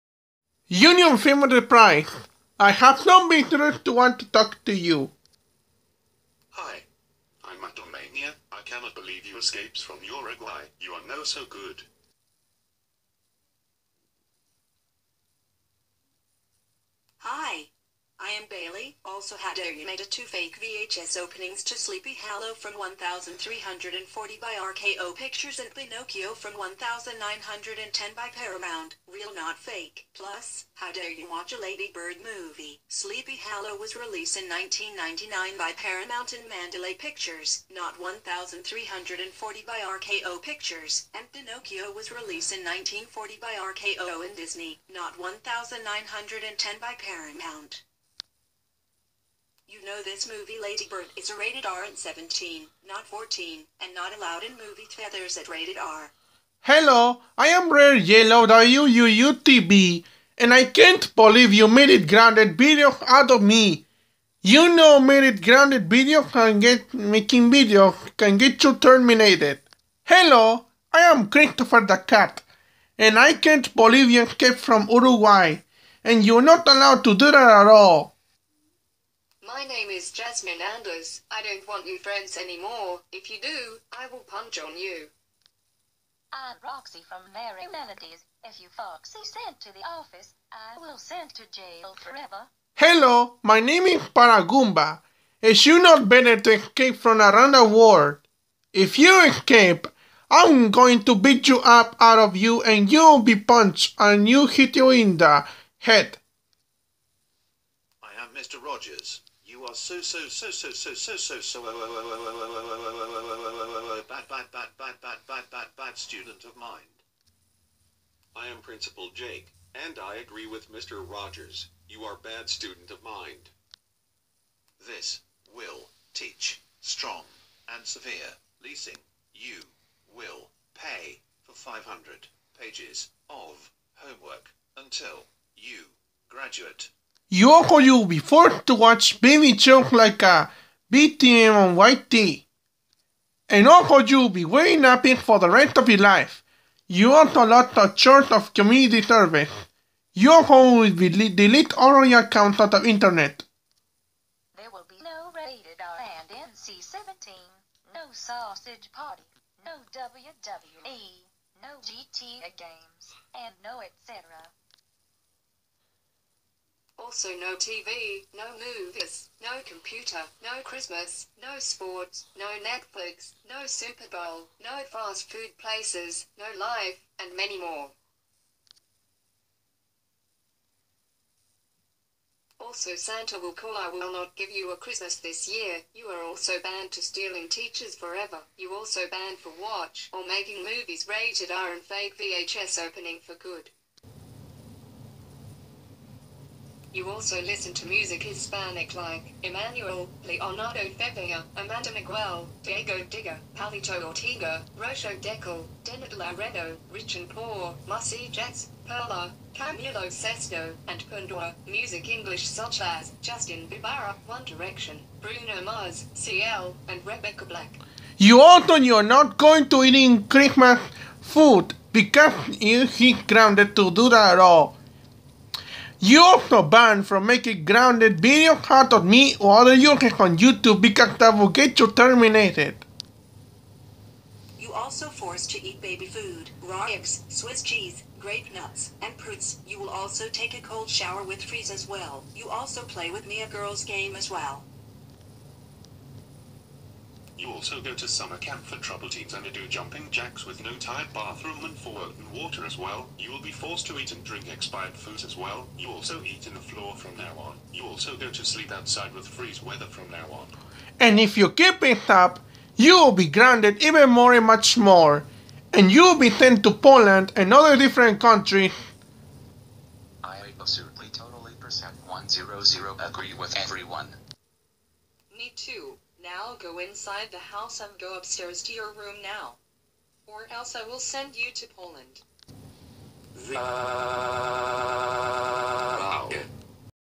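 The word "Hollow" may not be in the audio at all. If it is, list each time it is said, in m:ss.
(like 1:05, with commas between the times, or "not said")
0:22, 0:33.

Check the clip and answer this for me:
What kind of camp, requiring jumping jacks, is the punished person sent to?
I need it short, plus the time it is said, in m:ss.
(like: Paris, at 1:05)
Summer camp for trouble teens, at 4:08.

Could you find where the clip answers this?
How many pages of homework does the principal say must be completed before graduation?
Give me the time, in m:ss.
2:11.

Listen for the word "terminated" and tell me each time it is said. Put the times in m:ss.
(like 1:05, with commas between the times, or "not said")
1:08, 3:51.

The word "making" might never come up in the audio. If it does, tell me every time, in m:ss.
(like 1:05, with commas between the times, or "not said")
1:06, 3:10, 3:47.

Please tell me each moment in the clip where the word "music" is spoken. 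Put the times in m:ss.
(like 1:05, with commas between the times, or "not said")
3:17, 3:31.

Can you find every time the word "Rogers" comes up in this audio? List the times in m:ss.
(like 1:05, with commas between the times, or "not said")
1:48, 2:01.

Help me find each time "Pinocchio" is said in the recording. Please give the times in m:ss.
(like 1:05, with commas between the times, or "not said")
0:25, 0:41.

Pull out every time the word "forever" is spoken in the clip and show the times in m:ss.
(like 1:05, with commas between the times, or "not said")
1:32, 3:07.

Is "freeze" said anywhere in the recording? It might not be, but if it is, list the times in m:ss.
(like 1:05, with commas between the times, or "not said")
4:01, 4:19.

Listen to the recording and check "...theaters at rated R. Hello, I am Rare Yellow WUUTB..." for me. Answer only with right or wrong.
right.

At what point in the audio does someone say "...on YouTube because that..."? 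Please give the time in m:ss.
3:50.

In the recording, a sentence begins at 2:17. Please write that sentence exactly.
Yoho you forced to watch Baby Jump like a BTM on YT.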